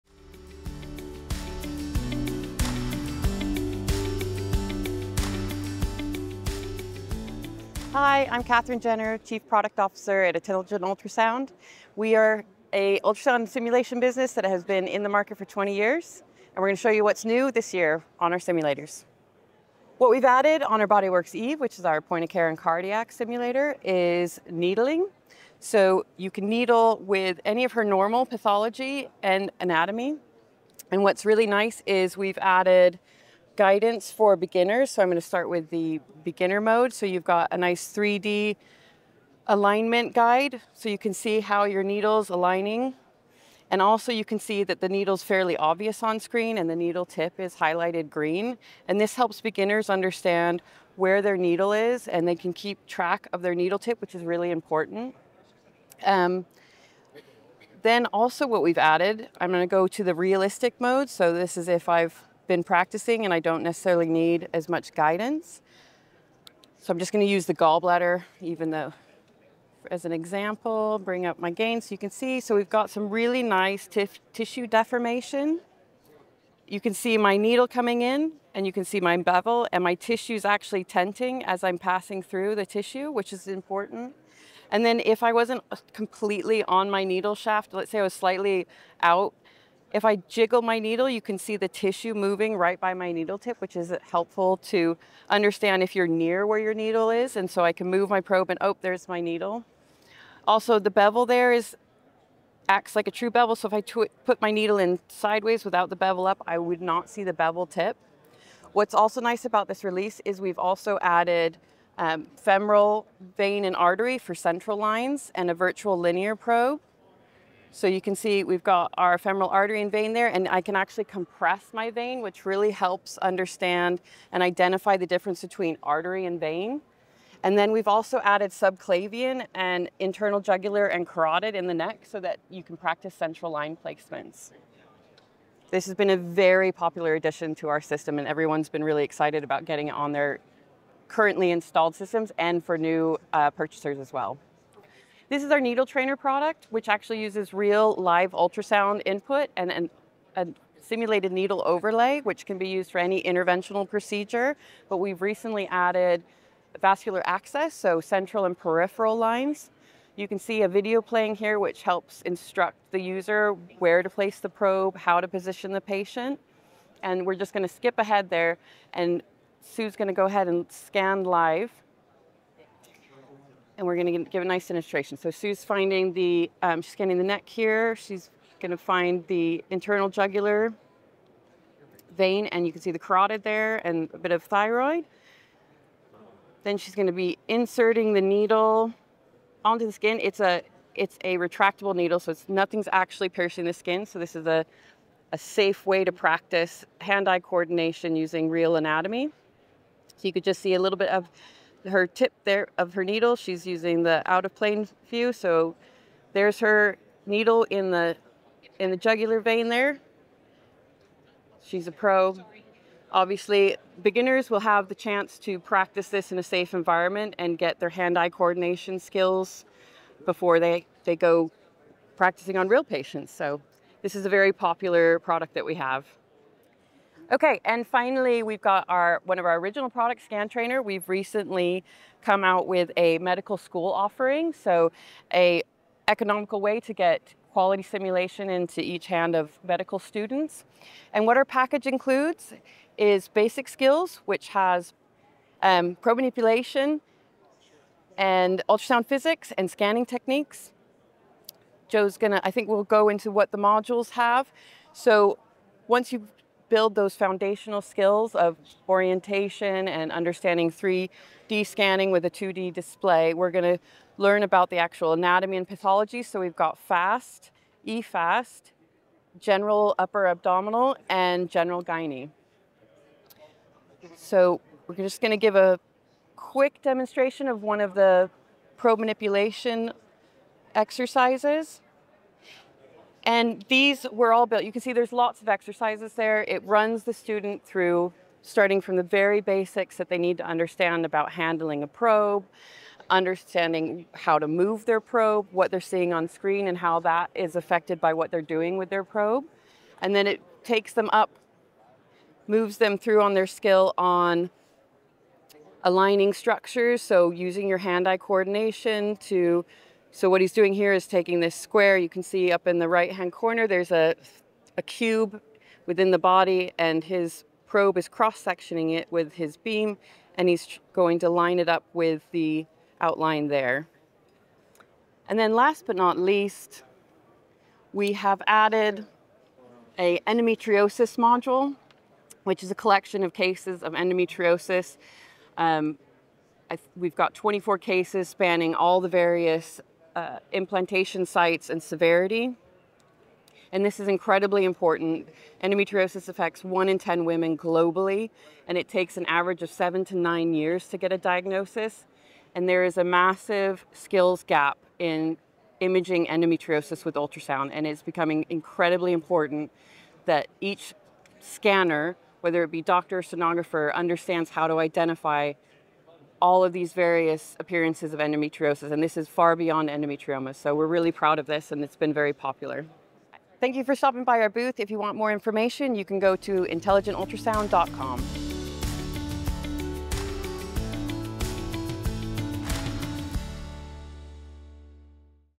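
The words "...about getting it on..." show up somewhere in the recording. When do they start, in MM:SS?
02:19.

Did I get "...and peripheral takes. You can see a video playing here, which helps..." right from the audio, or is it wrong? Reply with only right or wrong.
wrong.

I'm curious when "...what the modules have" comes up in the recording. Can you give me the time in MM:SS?
04:13.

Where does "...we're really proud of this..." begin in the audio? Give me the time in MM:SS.
06:10.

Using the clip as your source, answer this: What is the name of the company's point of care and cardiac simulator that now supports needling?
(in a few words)
BodyWorks Eve.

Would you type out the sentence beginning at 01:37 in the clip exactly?
And so I can move my probe and, oh, there's my needle.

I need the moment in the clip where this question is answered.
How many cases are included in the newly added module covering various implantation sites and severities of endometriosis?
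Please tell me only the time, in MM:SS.
05:37.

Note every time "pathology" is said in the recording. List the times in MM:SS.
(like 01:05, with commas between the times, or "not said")
00:28, 04:25.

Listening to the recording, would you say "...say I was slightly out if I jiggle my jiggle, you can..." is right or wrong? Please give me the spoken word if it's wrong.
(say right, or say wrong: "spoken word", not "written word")
wrong: "needle", not "jiggle".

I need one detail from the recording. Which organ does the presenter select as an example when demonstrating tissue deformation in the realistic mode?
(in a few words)
Gallbladder.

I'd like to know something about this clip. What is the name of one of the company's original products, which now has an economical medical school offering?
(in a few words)
Scan Trainer.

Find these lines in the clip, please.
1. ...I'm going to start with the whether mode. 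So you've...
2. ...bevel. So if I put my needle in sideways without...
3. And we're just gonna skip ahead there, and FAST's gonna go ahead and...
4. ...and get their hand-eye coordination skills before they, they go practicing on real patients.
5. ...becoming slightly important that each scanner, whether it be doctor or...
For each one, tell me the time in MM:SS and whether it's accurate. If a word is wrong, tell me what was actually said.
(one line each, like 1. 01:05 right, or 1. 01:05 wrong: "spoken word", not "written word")
1. 00:35 wrong: "beginner", not "whether"
2. 01:43 right
3. 02:47 wrong: "Sue", not "FAST"
4. 03:37 right
5. 05:58 wrong: "incredibly", not "slightly".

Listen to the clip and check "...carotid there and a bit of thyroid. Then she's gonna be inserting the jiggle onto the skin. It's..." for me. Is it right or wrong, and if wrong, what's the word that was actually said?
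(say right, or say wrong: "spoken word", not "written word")
wrong: "needle", not "jiggle".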